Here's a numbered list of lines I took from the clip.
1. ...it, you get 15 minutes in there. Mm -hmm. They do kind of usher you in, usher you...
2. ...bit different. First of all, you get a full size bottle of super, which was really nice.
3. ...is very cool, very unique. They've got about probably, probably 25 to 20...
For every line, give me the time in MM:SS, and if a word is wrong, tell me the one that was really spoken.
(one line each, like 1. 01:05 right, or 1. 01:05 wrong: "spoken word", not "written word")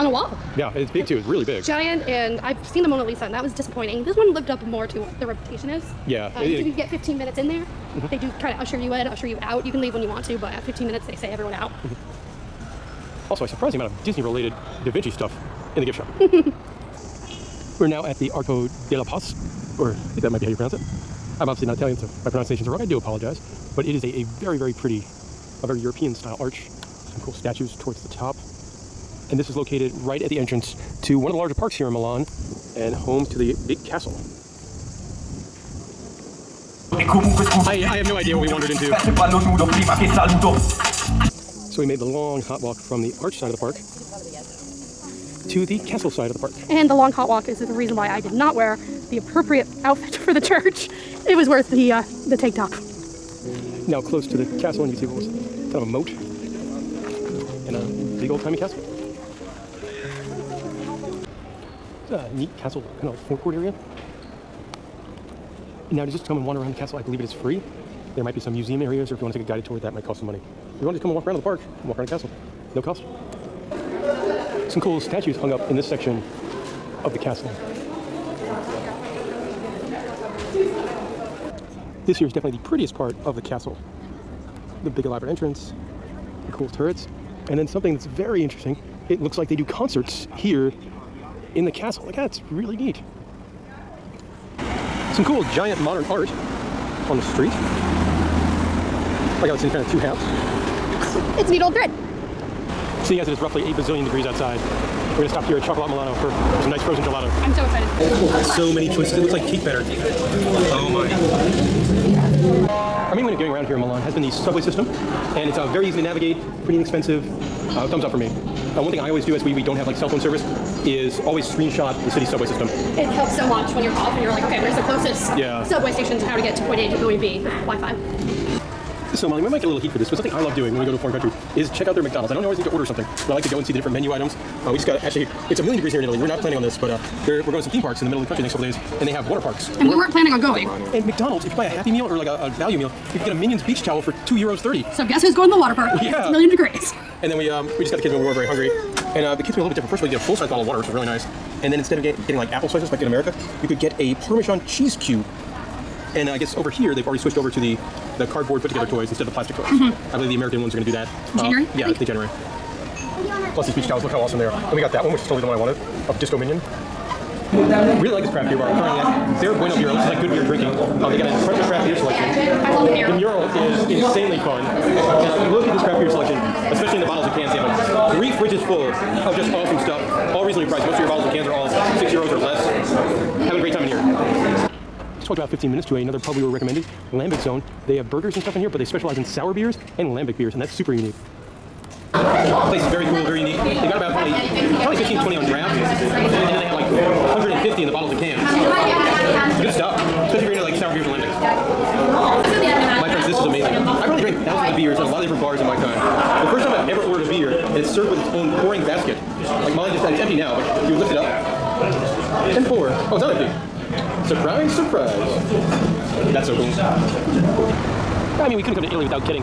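1. 00:06 right
2. 02:29 wrong: "water", not "super"
3. 03:12 wrong: "15", not "25".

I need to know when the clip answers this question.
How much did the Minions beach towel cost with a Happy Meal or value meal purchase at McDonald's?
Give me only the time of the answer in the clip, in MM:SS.
02:24.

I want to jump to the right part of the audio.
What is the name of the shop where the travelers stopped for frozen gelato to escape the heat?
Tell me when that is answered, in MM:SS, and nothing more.
01:45.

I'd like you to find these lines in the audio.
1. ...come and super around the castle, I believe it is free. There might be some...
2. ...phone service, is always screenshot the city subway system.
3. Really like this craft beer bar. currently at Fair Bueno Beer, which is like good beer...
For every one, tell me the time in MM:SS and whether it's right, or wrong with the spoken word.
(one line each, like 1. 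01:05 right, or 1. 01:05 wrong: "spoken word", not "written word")
1. 01:06 wrong: "wander", not "super"
2. 02:00 right
3. 02:48 right.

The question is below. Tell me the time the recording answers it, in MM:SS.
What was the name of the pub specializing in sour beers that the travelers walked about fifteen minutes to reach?
03:07.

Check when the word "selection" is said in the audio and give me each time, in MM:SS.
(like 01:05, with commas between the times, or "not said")
02:51, 02:56.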